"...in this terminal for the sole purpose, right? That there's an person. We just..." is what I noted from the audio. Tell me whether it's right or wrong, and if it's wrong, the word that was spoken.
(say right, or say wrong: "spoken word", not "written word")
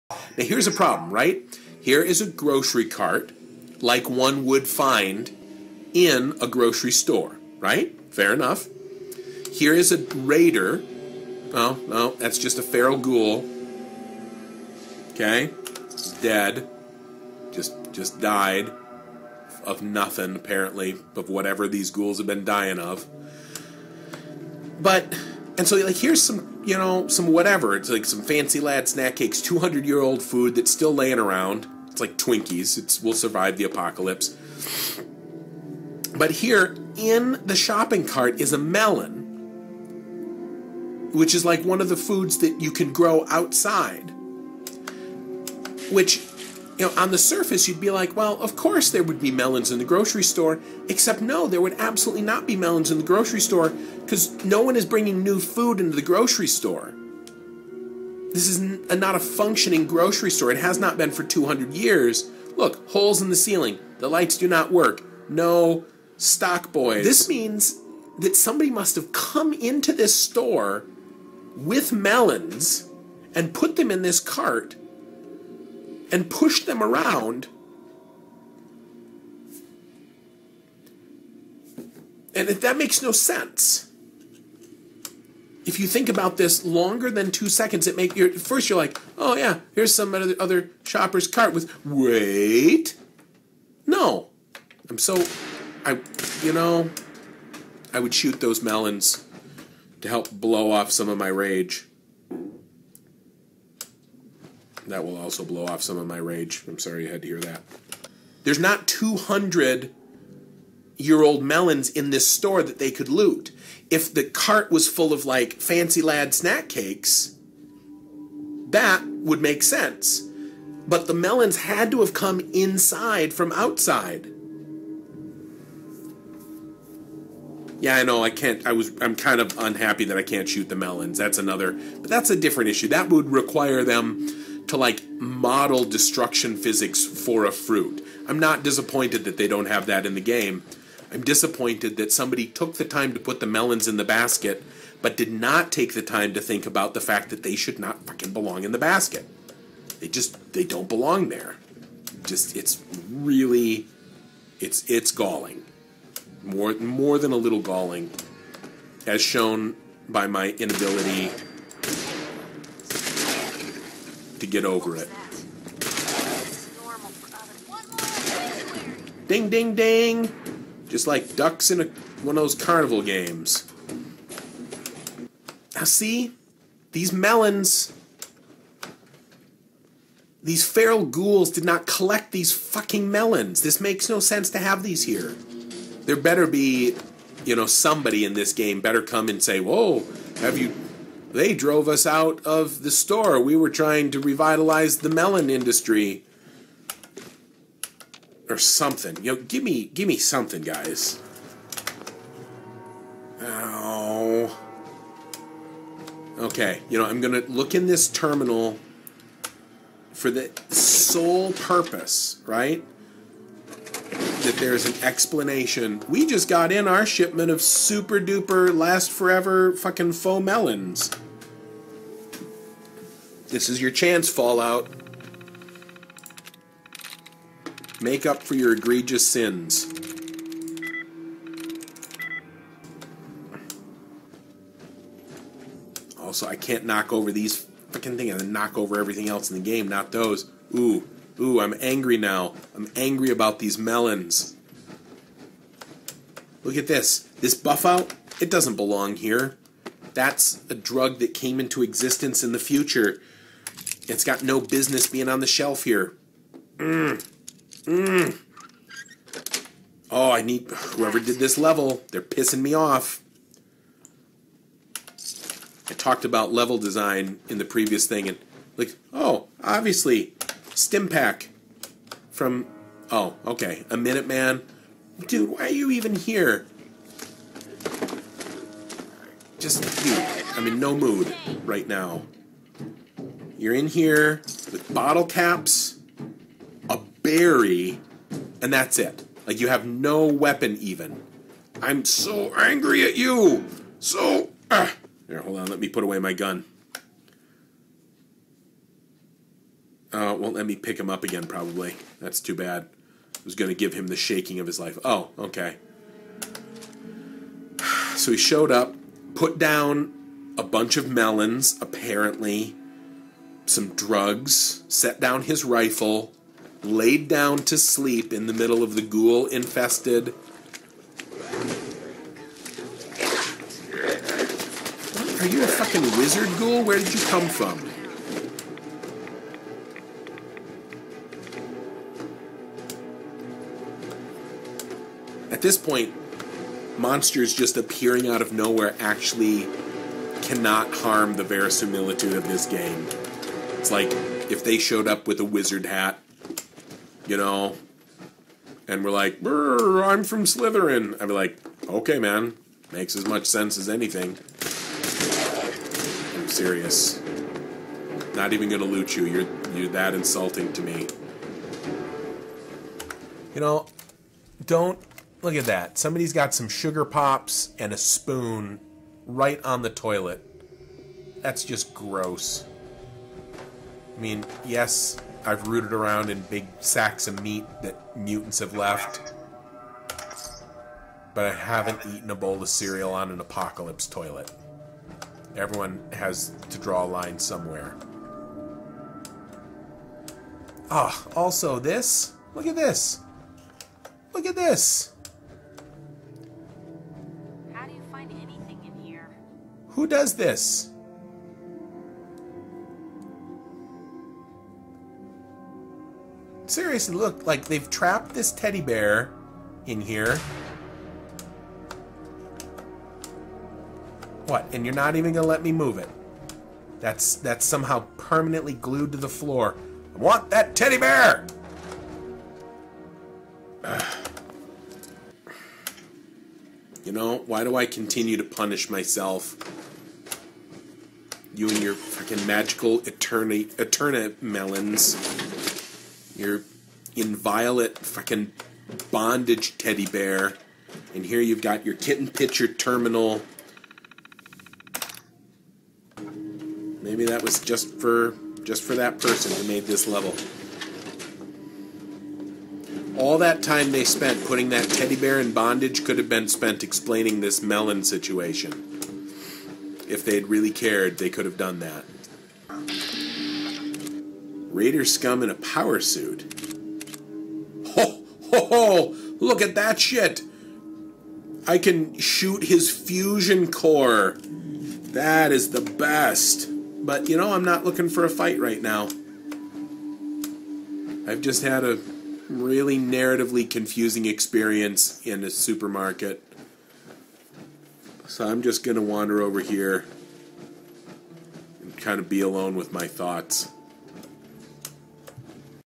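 wrong: "explanation", not "person".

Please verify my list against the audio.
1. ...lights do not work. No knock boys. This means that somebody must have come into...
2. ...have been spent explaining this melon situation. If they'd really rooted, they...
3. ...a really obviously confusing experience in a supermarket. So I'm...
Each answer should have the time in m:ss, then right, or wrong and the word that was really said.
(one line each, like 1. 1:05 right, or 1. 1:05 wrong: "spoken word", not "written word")
1. 1:04 wrong: "stock", not "knock"
2. 7:36 wrong: "cared", not "rooted"
3. 8:01 wrong: "narratively", not "obviously".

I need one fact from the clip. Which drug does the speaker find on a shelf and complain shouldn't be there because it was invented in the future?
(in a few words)
Buffout.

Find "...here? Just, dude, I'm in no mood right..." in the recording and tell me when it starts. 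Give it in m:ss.
4:36.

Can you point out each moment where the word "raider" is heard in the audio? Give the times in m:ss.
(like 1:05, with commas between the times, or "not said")
0:09, 7:44.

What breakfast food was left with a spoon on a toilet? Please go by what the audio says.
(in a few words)
sugar pops.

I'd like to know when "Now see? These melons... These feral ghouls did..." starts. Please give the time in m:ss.
2:55.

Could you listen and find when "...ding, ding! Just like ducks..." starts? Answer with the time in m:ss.
2:49.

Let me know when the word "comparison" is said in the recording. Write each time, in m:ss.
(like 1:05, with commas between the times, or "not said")
not said.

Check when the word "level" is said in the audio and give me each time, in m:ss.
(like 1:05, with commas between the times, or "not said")
4:21, 4:26, 7:30.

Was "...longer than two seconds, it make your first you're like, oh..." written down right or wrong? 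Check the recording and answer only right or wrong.
right.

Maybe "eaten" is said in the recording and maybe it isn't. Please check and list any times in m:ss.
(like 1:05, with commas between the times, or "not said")
6:22.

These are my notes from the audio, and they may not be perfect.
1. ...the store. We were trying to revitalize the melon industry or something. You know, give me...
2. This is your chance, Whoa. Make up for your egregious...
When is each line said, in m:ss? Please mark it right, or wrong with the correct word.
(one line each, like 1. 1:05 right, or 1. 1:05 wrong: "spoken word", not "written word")
1. 3:12 right
2. 3:43 wrong: "Fallout", not "Whoa".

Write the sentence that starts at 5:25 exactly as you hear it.
Are you a fucking wizard ghoul?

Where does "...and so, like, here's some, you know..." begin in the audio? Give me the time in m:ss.
0:25.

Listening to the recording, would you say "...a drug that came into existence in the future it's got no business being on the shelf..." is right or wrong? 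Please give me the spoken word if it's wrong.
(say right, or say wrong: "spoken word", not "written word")
right.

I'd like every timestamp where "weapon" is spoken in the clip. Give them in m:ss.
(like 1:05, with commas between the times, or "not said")
4:50.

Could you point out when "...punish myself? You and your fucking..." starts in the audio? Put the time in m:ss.
7:08.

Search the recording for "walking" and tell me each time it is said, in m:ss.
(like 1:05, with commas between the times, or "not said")
not said.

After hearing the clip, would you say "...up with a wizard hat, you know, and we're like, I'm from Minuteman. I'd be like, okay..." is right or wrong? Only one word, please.
wrong.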